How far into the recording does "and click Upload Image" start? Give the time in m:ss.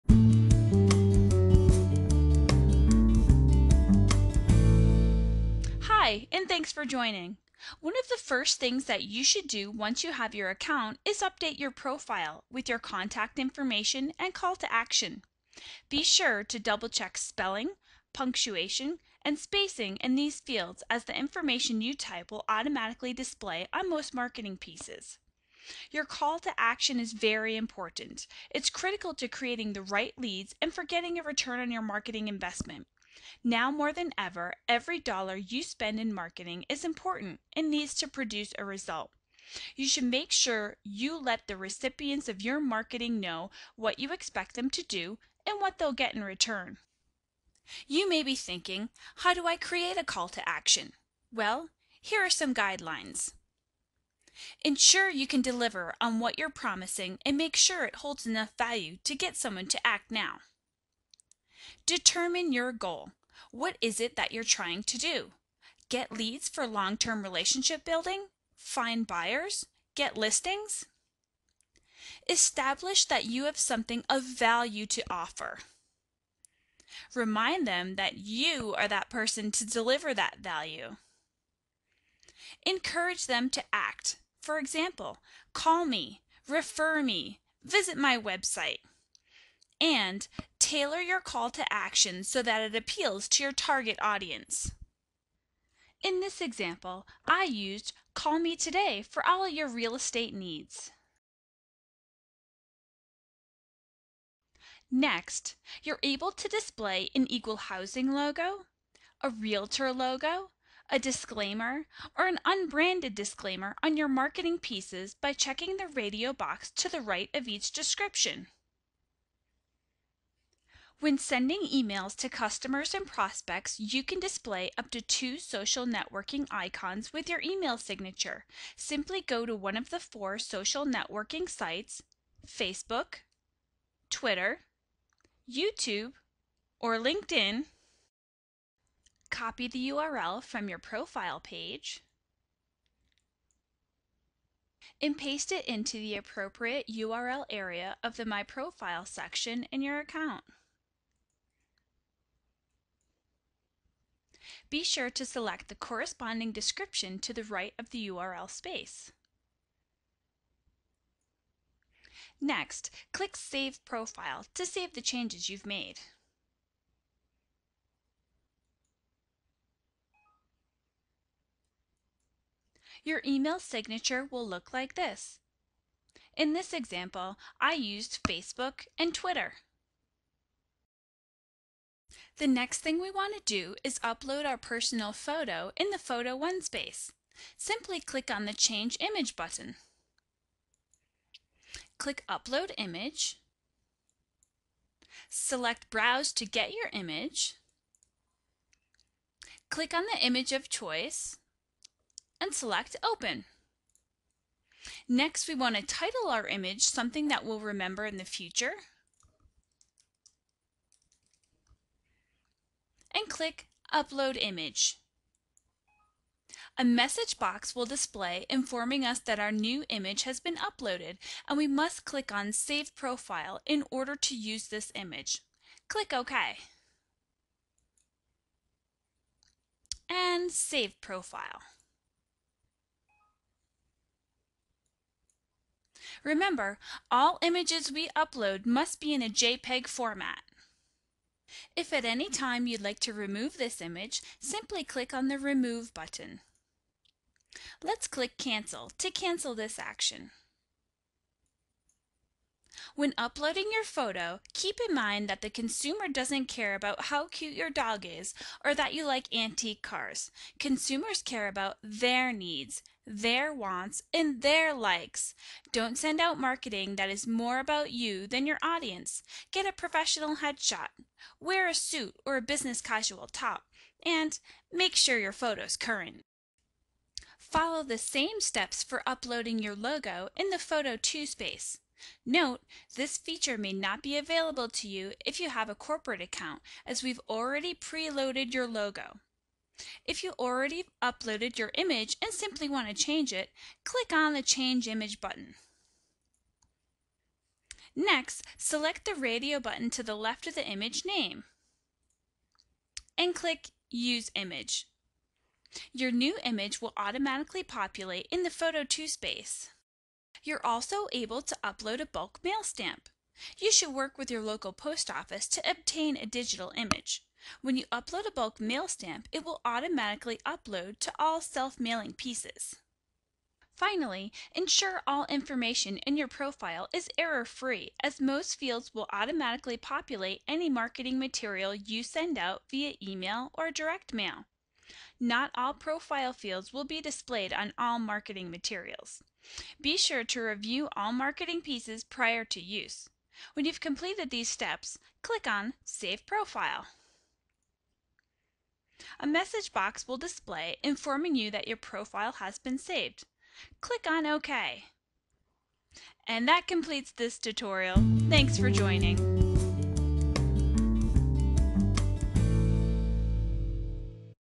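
3:33.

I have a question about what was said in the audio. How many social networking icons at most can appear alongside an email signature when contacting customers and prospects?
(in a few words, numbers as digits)
2.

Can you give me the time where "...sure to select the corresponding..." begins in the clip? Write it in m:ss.
2:34.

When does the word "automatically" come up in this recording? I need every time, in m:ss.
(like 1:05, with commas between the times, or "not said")
0:22, 5:06, 5:19, 5:29.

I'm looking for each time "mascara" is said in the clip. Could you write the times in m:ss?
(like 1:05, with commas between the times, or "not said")
not said.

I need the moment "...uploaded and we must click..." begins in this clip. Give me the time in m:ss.
3:40.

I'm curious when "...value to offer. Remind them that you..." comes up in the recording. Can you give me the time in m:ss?
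1:14.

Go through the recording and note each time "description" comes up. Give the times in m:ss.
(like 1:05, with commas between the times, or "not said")
1:57, 2:36.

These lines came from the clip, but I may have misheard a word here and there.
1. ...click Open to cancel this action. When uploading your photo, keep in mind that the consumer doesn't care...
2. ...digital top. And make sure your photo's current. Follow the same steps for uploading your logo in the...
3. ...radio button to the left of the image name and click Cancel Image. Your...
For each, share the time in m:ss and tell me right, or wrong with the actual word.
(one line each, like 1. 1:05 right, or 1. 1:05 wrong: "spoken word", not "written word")
1. 4:08 wrong: "Cancel", not "Open"
2. 4:32 wrong: "casual", not "digital"
3. 4:59 wrong: "Use", not "Cancel".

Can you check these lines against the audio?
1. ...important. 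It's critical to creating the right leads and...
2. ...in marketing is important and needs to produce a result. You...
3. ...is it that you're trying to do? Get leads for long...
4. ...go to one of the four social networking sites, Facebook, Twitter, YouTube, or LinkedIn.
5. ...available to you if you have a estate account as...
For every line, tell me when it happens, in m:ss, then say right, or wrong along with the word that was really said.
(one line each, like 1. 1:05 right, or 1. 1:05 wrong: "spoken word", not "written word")
1. 0:27 right
2. 0:35 right
3. 1:03 right
4. 2:09 right
5. 4:44 wrong: "corporate", not "estate".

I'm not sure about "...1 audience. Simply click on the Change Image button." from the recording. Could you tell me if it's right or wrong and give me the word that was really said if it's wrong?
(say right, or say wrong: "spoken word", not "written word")
wrong: "space", not "audience".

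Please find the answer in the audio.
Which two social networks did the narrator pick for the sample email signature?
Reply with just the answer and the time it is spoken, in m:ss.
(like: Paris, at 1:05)
Facebook and Twitter, at 2:58.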